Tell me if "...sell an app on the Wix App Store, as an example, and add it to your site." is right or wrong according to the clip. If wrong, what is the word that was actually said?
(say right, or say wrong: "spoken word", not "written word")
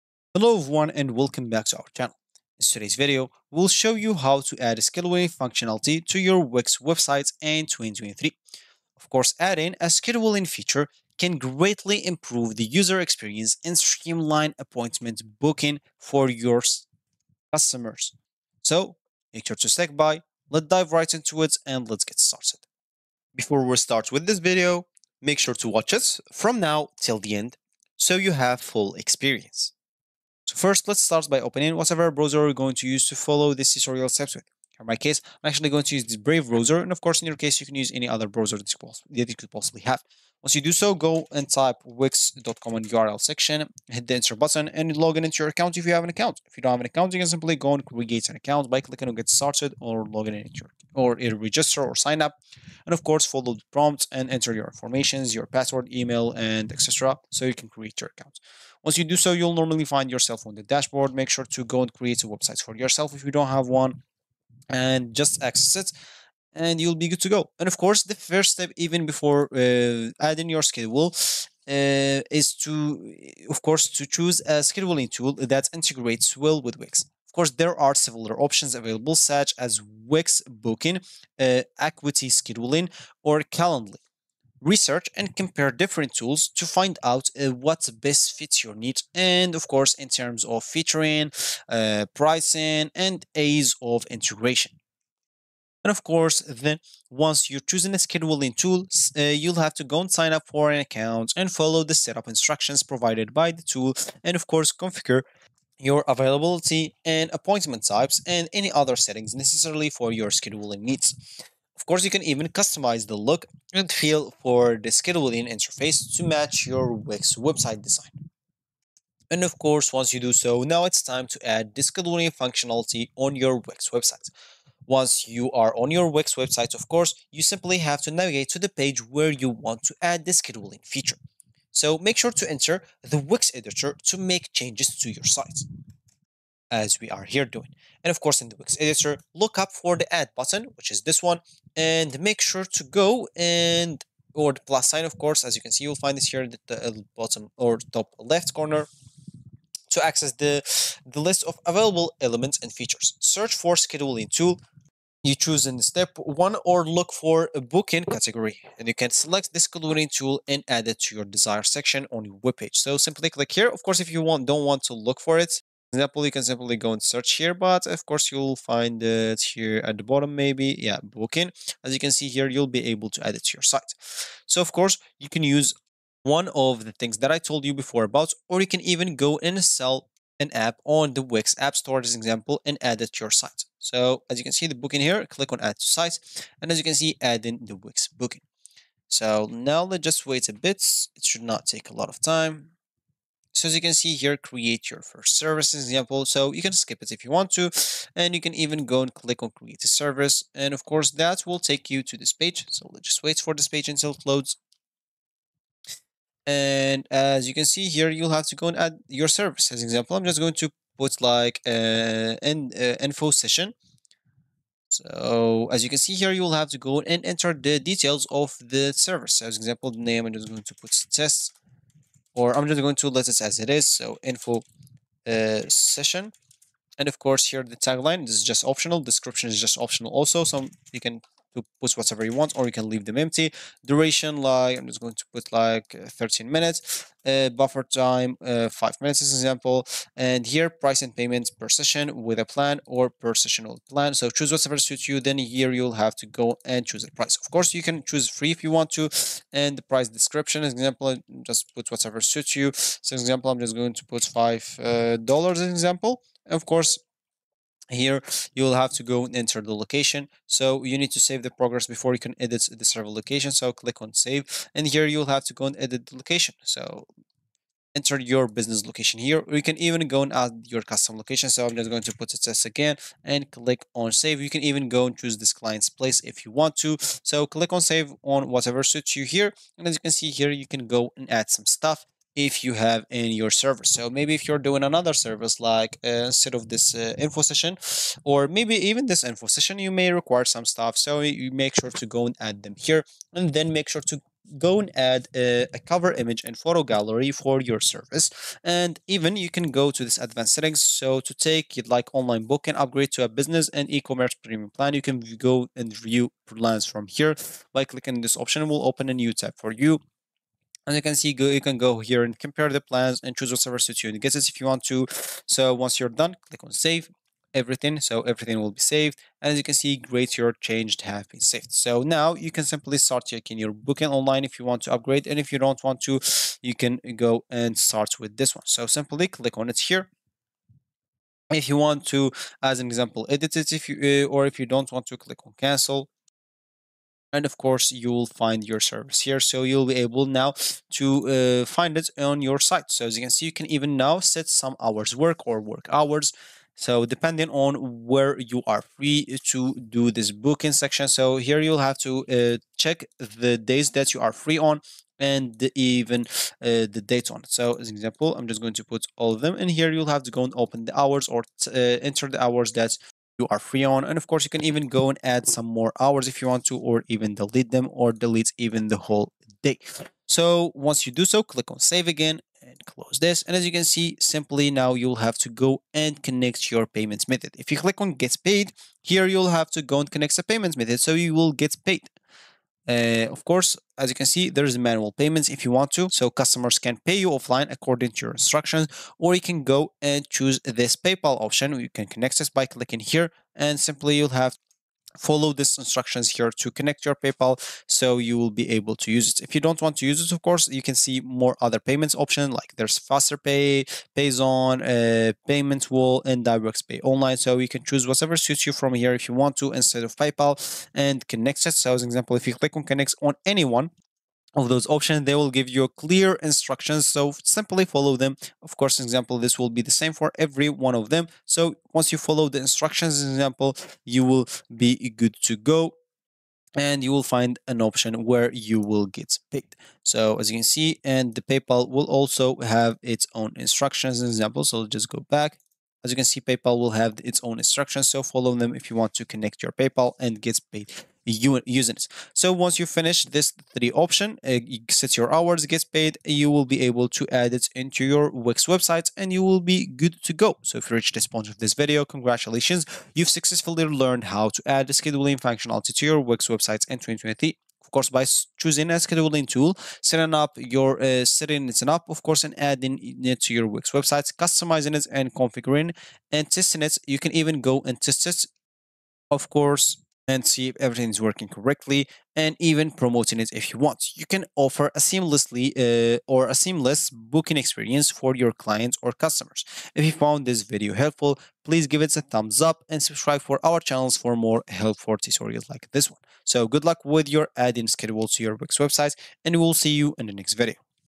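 right.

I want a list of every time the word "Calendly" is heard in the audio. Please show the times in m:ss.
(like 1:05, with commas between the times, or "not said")
1:23.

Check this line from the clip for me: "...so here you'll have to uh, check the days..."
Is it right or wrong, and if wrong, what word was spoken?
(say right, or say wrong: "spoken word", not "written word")
right.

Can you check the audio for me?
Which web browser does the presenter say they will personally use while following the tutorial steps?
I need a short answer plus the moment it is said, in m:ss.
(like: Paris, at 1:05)
Brave, at 0:36.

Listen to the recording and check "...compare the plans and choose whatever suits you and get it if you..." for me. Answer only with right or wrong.
right.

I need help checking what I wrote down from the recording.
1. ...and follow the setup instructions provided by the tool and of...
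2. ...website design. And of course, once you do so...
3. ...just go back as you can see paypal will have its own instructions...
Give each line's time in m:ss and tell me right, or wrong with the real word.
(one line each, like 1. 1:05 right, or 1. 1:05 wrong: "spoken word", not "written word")
1. 1:41 right
2. 1:57 right
3. 7:14 right.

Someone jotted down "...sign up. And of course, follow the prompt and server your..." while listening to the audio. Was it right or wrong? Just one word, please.
wrong.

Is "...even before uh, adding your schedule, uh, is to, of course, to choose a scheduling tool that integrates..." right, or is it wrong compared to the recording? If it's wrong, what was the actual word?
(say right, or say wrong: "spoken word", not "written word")
right.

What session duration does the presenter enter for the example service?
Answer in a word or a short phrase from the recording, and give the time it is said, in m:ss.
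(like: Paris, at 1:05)
13 minutes, at 3:56.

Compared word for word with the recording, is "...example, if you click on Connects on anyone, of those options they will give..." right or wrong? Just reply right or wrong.
right.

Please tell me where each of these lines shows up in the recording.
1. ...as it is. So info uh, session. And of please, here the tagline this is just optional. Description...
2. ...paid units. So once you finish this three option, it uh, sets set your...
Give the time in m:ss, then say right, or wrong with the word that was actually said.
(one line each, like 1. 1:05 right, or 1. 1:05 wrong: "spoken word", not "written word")
1. 3:43 wrong: "course", not "please"
2. 7:20 right.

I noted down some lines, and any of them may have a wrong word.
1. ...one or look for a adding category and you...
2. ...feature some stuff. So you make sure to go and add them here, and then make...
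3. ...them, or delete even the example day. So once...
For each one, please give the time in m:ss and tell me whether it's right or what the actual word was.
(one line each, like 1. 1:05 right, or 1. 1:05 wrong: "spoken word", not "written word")
1. 2:36 wrong: "booking", not "adding"
2. 4:50 wrong: "require", not "feature"
3. 6:07 wrong: "whole", not "example".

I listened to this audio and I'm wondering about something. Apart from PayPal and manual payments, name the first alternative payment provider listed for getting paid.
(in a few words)
FasterPay.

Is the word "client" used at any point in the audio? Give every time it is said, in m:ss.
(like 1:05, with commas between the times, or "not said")
4:35, 7:58.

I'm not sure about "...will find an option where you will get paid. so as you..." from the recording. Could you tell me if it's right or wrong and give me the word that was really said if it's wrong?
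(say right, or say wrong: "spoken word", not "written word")
right.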